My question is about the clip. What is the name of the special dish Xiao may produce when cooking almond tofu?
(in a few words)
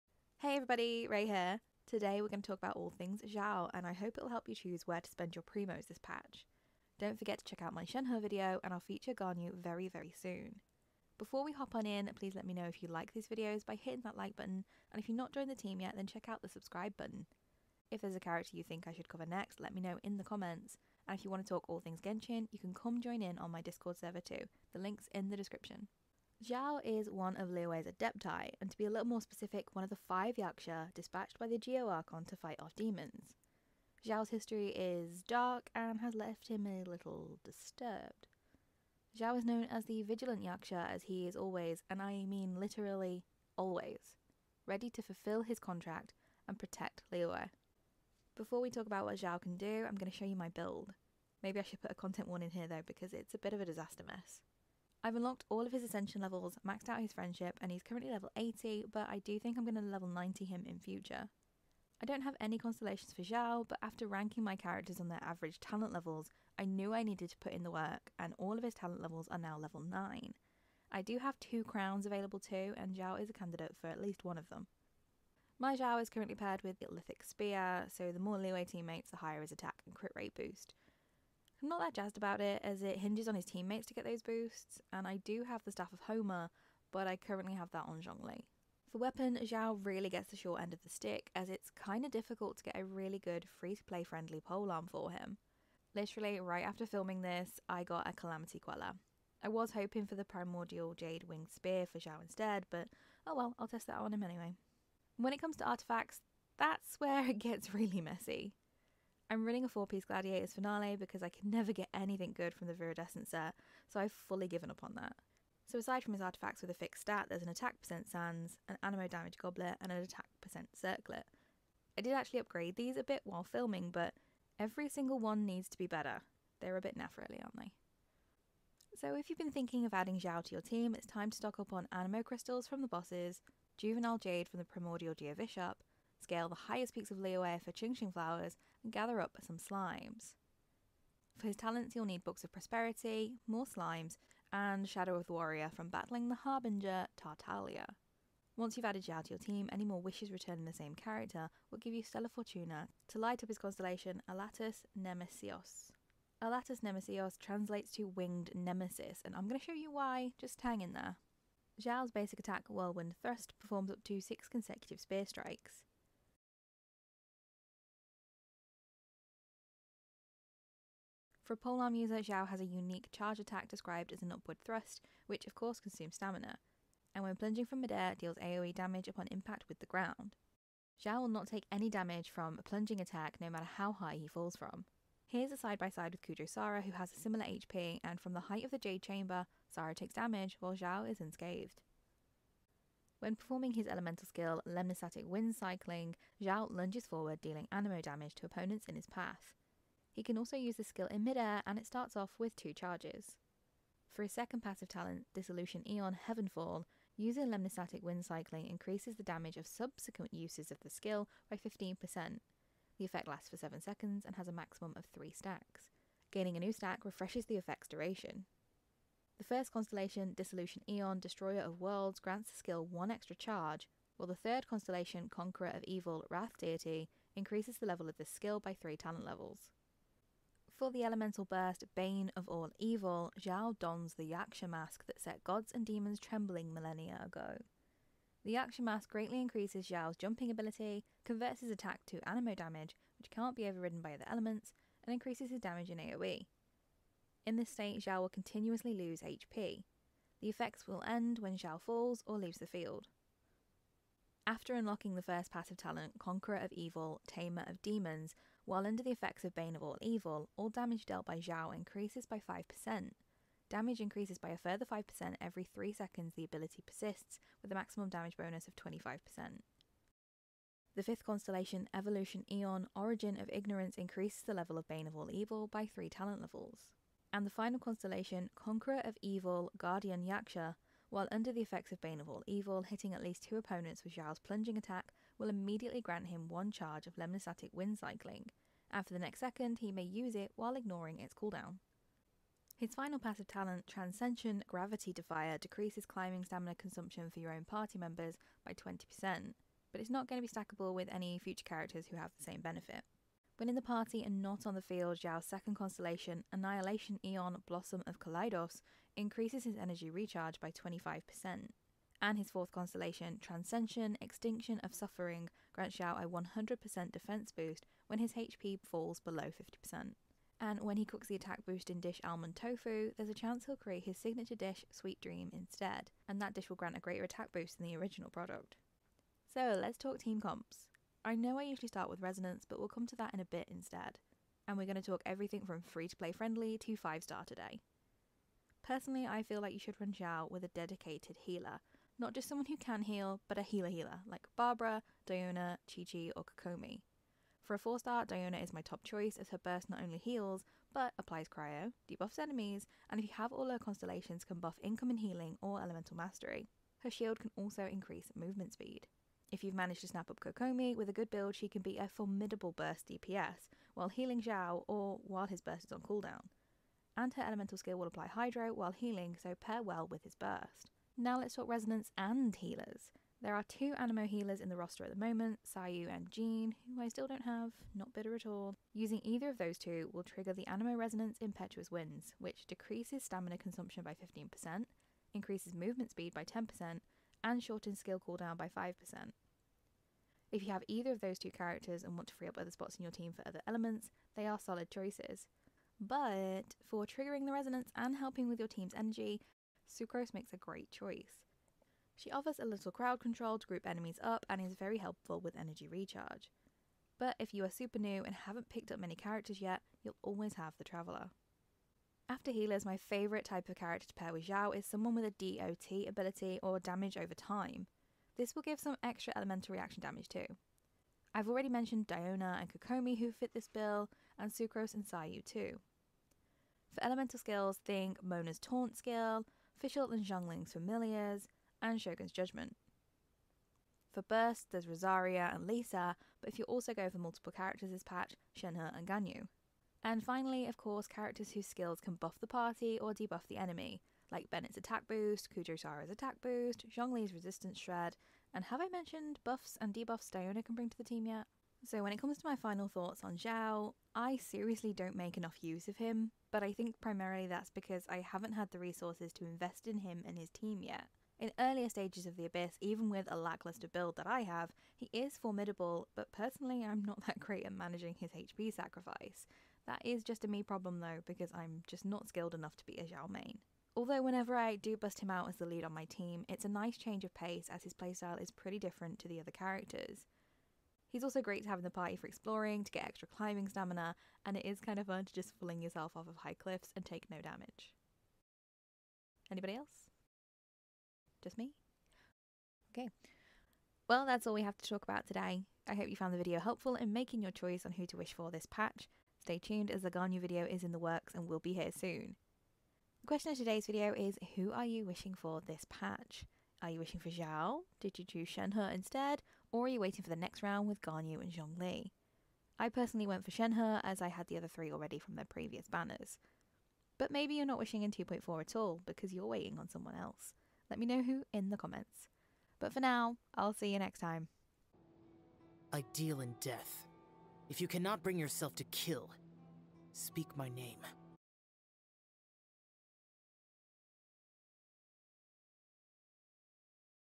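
Sweet Dream.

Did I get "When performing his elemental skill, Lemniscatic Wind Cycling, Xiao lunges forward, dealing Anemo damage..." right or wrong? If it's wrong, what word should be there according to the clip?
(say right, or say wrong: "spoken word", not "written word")
right.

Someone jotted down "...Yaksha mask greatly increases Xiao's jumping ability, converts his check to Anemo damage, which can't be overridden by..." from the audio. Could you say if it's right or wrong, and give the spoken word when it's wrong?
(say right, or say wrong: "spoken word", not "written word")
wrong: "attack", not "check".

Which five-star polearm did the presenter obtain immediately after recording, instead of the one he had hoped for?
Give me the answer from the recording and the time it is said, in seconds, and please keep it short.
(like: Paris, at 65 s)
Calamity Queller, at 98 s.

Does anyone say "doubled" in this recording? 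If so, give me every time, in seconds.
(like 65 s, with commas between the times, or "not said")
not said.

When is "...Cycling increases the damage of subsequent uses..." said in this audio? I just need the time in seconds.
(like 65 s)
208 s.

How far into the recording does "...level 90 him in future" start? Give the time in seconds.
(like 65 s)
59 s.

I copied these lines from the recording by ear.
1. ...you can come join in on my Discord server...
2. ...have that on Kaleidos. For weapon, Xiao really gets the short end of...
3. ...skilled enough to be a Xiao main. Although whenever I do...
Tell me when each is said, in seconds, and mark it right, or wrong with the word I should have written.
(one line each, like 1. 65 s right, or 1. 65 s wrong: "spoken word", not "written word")
1. 22 s right
2. 87 s wrong: "Zhongli", not "Kaleidos"
3. 472 s right.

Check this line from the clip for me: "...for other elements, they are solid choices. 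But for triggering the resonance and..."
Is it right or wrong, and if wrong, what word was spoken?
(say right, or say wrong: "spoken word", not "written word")
right.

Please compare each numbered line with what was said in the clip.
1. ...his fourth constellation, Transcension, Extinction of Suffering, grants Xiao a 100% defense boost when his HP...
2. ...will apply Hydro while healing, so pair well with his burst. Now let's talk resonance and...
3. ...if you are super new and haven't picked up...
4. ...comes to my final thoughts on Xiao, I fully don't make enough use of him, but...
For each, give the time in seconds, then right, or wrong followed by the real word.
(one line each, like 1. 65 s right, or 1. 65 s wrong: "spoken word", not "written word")
1. 312 s right
2. 367 s right
3. 407 s right
4. 452 s wrong: "seriously", not "fully".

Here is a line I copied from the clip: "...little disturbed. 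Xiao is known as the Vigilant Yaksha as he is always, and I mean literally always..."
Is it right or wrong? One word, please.
right.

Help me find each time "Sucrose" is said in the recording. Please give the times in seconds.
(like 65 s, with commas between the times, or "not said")
399 s, 424 s.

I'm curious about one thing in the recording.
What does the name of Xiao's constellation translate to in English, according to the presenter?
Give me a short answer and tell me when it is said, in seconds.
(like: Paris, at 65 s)
Winged Nemesis, at 158 s.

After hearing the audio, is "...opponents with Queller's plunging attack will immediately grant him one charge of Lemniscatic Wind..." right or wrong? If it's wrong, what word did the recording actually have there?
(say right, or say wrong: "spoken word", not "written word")
wrong: "Xiao", not "Queller".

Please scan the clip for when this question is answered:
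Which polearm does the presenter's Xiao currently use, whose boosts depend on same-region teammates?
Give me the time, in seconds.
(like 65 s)
76 s.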